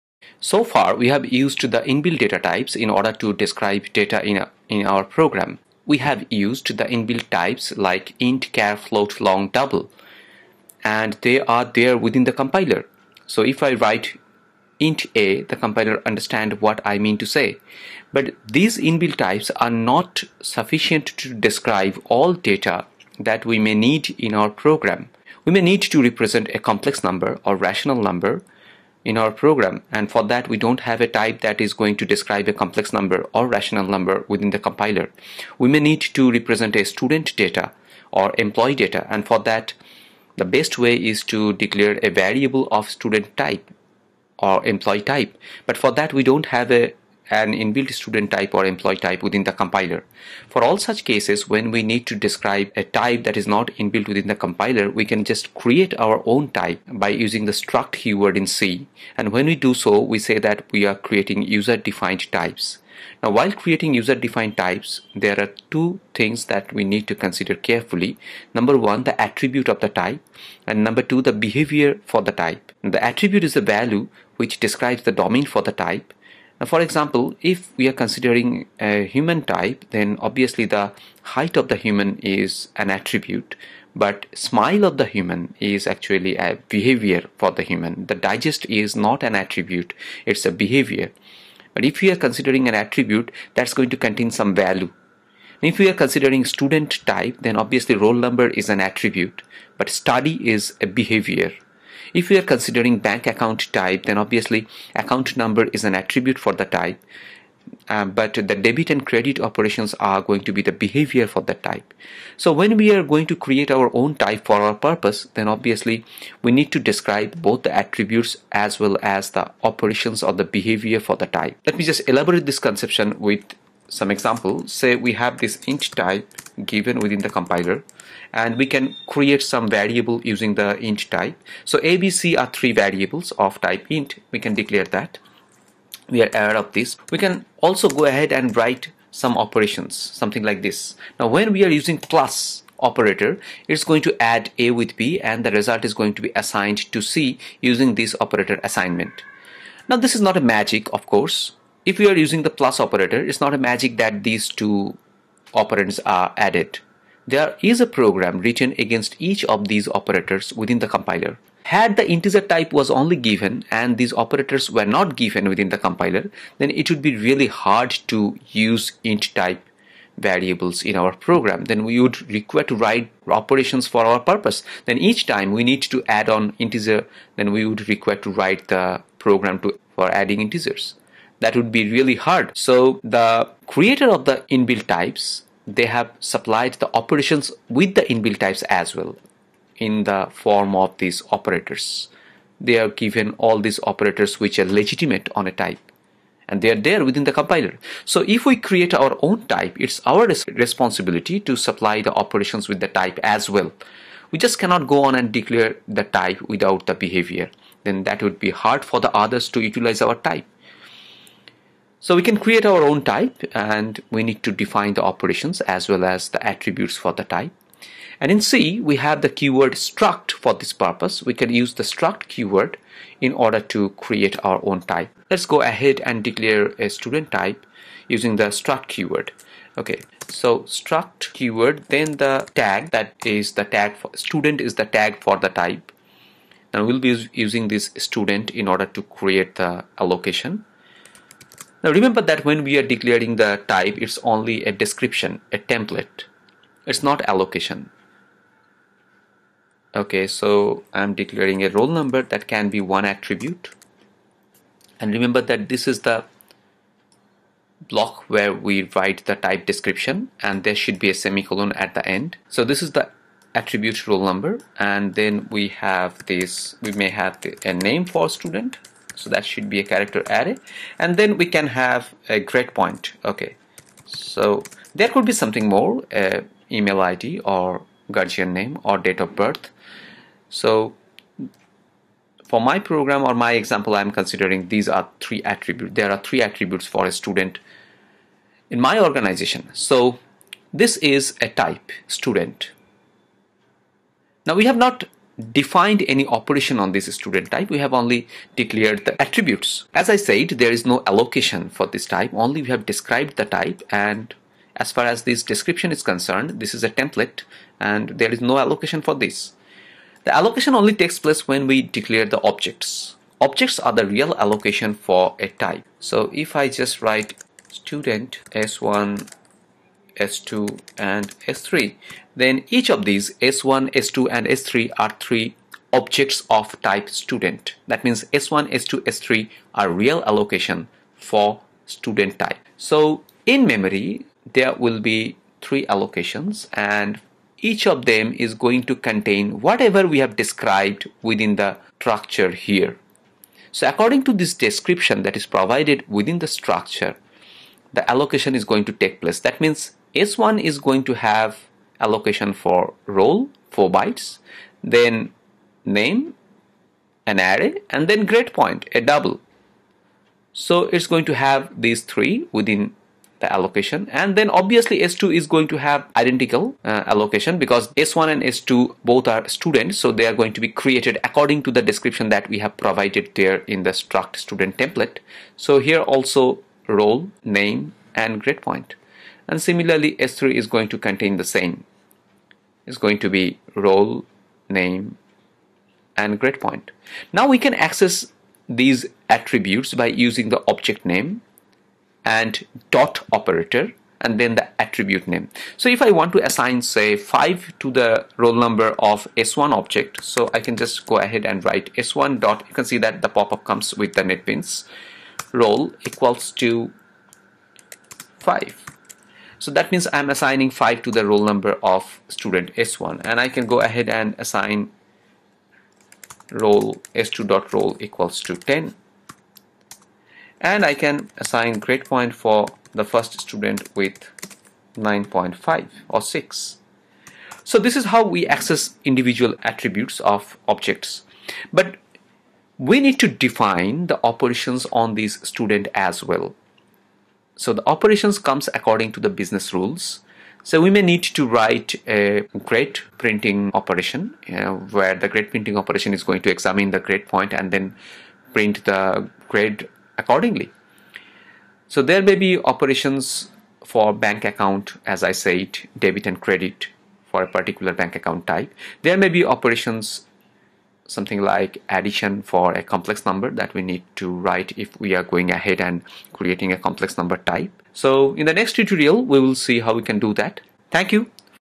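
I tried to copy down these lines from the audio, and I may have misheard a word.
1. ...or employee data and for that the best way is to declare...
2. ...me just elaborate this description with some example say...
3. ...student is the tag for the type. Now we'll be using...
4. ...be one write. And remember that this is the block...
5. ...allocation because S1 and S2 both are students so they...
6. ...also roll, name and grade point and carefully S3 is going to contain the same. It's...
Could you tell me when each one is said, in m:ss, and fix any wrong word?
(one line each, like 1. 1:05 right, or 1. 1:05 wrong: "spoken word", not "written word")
1. 0:38 right
2. 2:01 wrong: "conception", not "description"
3. 3:54 right
4. 4:12 wrong: "attribute", not "write"
5. 6:07 right
6. 6:16 wrong: "similarly", not "carefully".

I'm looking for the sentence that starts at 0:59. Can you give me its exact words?
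And when we do so, we say that we are creating user-defined types.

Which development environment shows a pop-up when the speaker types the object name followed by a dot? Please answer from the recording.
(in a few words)
NetBeans.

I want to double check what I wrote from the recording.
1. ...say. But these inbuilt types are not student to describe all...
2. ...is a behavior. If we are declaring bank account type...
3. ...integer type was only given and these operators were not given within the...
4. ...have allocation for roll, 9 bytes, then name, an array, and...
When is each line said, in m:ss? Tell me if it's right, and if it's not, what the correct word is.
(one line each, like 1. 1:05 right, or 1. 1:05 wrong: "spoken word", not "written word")
1. 0:17 wrong: "sufficient", not "student"
2. 1:40 wrong: "considering", not "declaring"
3. 2:42 right
4. 5:51 wrong: "4", not "9".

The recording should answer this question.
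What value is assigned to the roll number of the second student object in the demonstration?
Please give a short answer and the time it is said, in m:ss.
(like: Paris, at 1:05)
10, at 6:58.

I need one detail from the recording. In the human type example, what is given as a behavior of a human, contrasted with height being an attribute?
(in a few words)
Smile.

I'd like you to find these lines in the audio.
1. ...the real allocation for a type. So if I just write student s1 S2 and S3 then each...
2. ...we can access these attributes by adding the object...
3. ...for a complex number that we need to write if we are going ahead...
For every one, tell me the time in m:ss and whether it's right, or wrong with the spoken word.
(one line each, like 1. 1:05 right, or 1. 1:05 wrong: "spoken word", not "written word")
1. 5:13 right
2. 6:27 wrong: "using", not "adding"
3. 7:42 right.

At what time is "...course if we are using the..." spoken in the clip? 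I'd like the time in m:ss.
2:31.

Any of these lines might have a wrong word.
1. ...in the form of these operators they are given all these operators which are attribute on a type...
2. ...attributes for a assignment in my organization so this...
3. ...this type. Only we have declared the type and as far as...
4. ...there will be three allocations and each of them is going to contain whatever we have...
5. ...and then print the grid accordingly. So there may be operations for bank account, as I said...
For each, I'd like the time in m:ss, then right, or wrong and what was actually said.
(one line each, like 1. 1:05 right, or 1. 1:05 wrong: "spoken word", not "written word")
1. 3:09 wrong: "legitimate", not "attribute"
2. 4:46 wrong: "student", not "assignment"
3. 5:01 wrong: "described", not "declared"
4. 5:34 right
5. 7:27 right.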